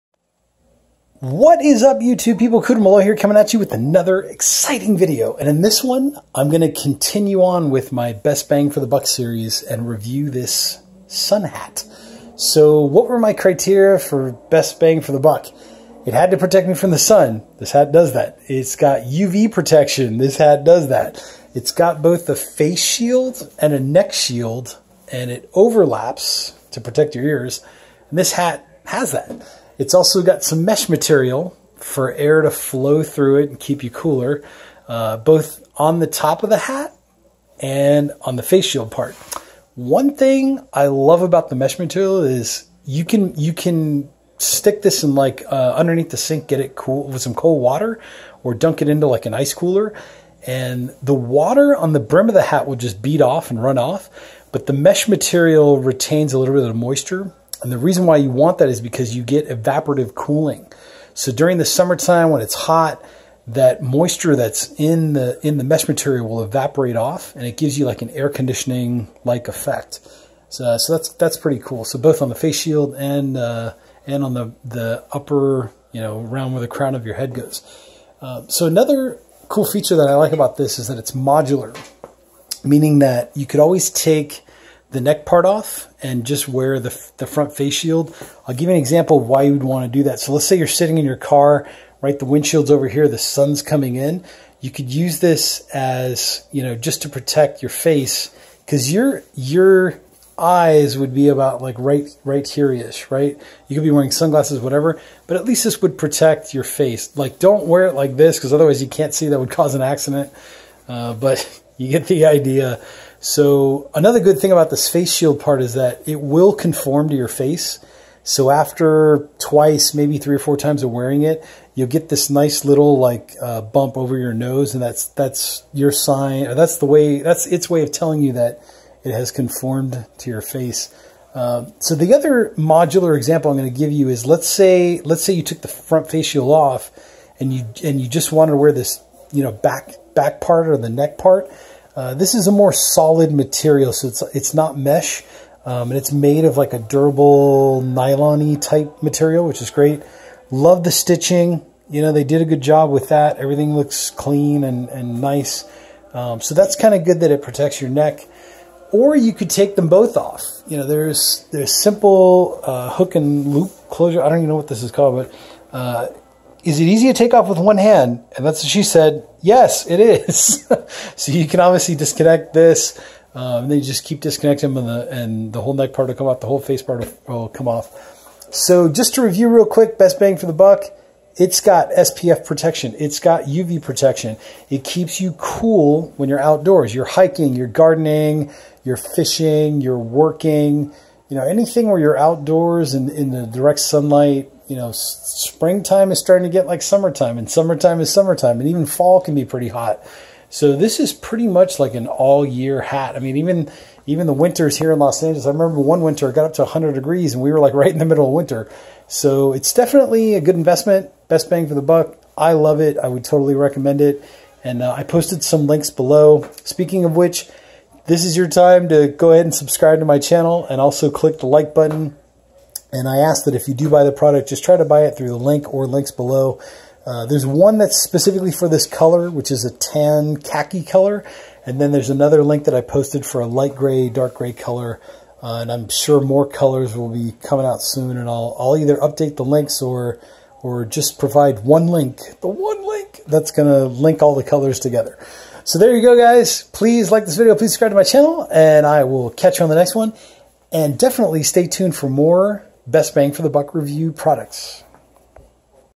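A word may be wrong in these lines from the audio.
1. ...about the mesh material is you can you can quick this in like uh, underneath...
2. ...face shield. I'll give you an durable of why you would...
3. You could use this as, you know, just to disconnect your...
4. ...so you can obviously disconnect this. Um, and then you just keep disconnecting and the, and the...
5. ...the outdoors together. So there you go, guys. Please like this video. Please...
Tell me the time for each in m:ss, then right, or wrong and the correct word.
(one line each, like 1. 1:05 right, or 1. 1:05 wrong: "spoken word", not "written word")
1. 0:41 wrong: "stick", not "quick"
2. 1:27 wrong: "example", not "durable"
3. 1:34 wrong: "protect", not "disconnect"
4. 2:51 right
5. 4:04 wrong: "colors", not "outdoors".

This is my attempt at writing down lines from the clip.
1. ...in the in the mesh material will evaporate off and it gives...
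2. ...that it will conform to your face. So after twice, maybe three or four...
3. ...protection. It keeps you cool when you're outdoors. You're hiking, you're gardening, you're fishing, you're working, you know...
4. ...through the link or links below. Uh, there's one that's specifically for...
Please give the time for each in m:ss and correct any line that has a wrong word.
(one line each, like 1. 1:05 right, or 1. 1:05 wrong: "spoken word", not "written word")
1. 1:04 right
2. 1:55 right
3. 3:03 right
4. 3:45 right.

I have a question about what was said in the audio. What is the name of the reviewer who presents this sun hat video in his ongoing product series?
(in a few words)
Cooter Malloy.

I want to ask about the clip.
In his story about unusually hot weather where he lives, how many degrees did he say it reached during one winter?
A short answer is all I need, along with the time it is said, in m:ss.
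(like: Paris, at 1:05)
100, at 3:26.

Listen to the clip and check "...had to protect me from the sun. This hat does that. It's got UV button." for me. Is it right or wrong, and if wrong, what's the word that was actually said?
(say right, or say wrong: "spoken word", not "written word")
wrong: "protection", not "button".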